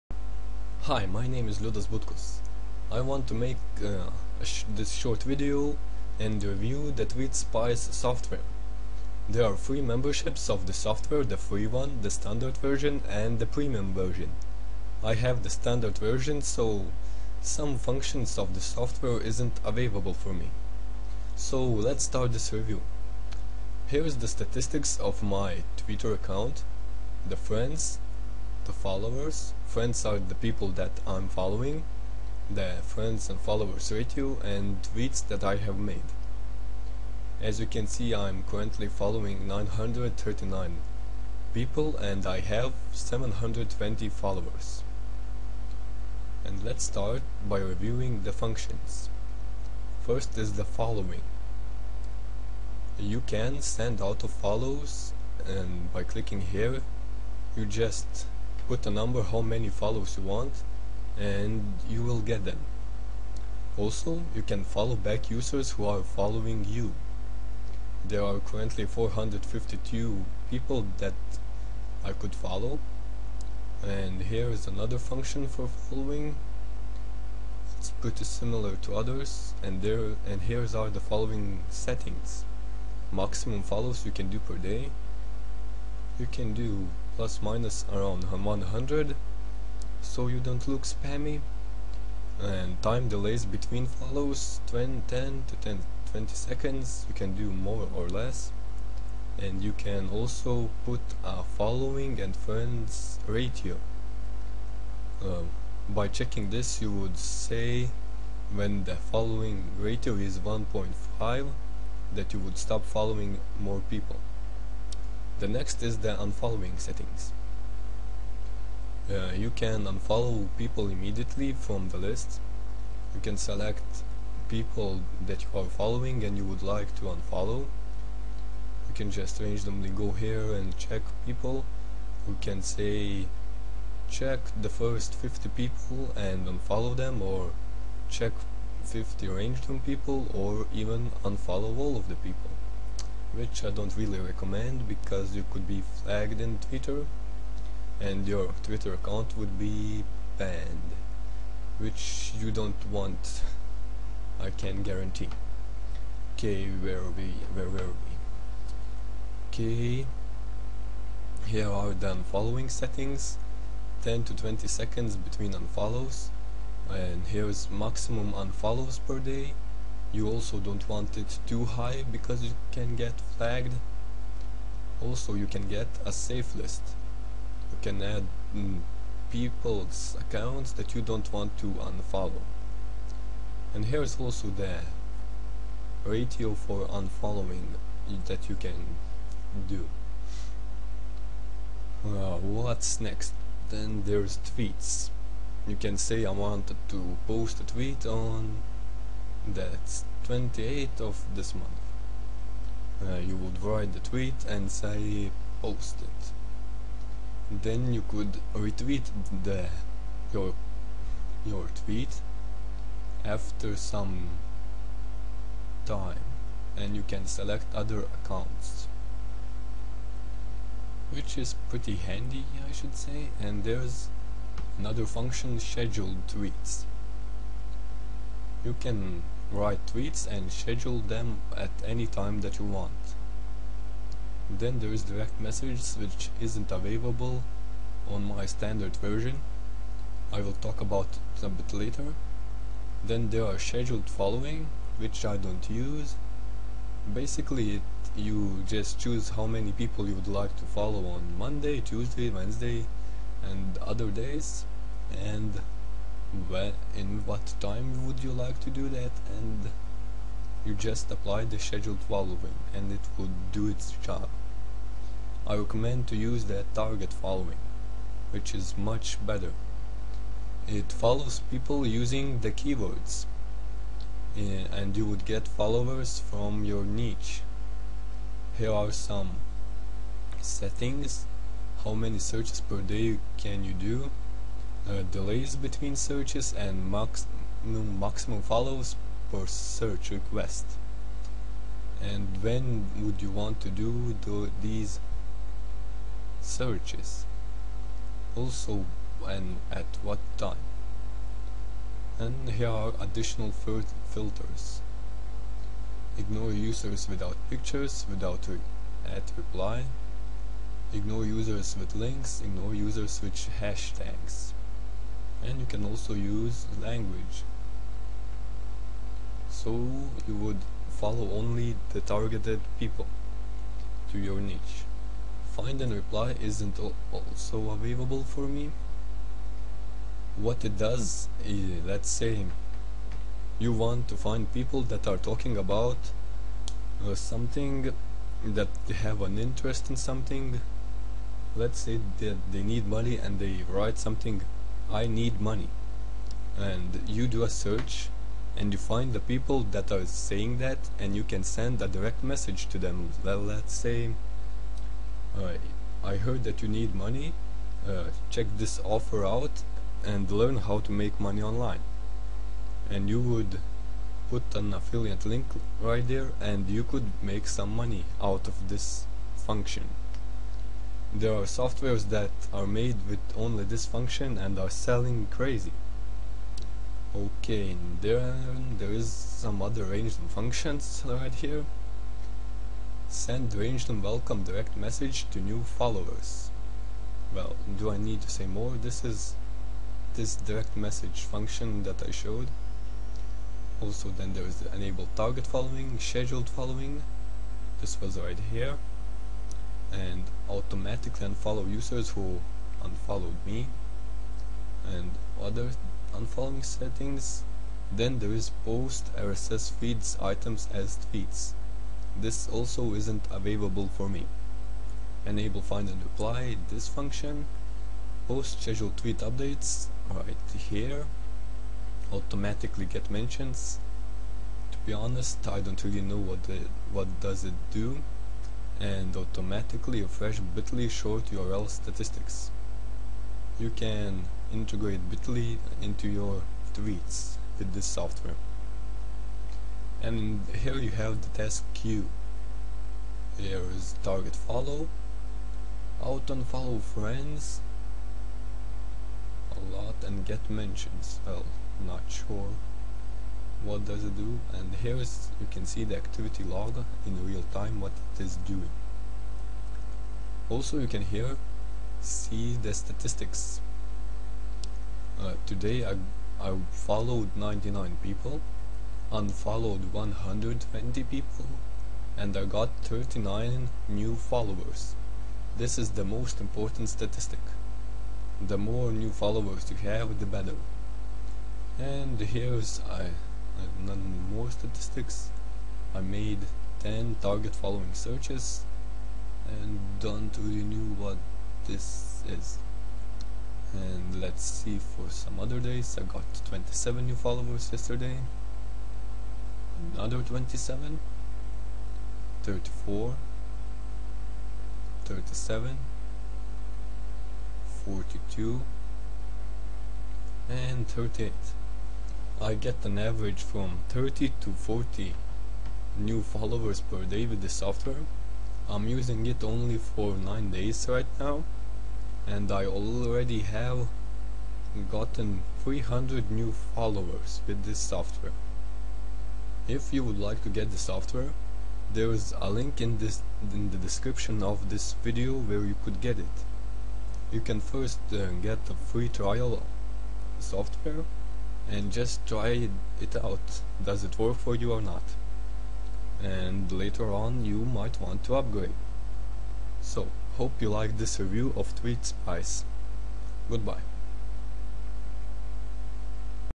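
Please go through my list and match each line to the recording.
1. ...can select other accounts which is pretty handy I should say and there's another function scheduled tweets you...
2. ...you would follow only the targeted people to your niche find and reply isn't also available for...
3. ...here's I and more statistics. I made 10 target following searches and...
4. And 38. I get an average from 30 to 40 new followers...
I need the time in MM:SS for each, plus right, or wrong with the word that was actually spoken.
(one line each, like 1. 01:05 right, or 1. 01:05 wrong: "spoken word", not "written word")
1. 03:37 right
2. 05:20 right
3. 08:02 right
4. 08:30 right.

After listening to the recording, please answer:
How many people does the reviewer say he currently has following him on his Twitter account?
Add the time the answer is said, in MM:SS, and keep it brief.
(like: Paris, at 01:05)
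720, at 00:42.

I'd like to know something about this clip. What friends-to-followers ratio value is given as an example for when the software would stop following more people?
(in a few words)
1.5.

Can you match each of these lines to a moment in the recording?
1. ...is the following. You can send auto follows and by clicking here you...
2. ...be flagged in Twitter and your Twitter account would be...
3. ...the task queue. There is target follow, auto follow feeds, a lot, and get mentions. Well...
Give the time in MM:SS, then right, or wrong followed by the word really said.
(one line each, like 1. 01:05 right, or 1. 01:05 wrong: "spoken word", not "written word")
1. 00:50 right
2. 02:25 right
3. 07:21 wrong: "friends", not "feeds".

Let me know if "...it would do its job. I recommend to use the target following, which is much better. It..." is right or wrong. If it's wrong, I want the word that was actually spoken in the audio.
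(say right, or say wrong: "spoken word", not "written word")
right.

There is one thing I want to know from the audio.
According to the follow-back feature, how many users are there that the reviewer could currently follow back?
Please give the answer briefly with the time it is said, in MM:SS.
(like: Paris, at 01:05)
452, at 01:08.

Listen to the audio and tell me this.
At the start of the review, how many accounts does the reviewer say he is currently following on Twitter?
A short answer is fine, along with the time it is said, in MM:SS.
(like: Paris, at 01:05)
939, at 00:39.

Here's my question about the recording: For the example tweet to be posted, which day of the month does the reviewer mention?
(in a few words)
28th.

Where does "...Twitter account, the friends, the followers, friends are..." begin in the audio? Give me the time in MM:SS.
00:25.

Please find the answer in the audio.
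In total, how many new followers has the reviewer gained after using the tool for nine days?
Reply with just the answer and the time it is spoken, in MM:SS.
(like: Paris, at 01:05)
300, at 08:45.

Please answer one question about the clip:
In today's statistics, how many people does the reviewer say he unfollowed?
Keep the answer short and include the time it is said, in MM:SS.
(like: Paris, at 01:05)
120, at 07:49.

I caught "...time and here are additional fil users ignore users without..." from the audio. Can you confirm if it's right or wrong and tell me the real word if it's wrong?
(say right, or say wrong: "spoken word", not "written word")
wrong: "filters", not "users".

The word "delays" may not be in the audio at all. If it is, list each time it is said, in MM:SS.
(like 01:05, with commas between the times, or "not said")
01:33, 04:45.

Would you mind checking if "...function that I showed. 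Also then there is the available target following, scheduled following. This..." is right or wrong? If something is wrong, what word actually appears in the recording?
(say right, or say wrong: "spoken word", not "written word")
wrong: "enable", not "available".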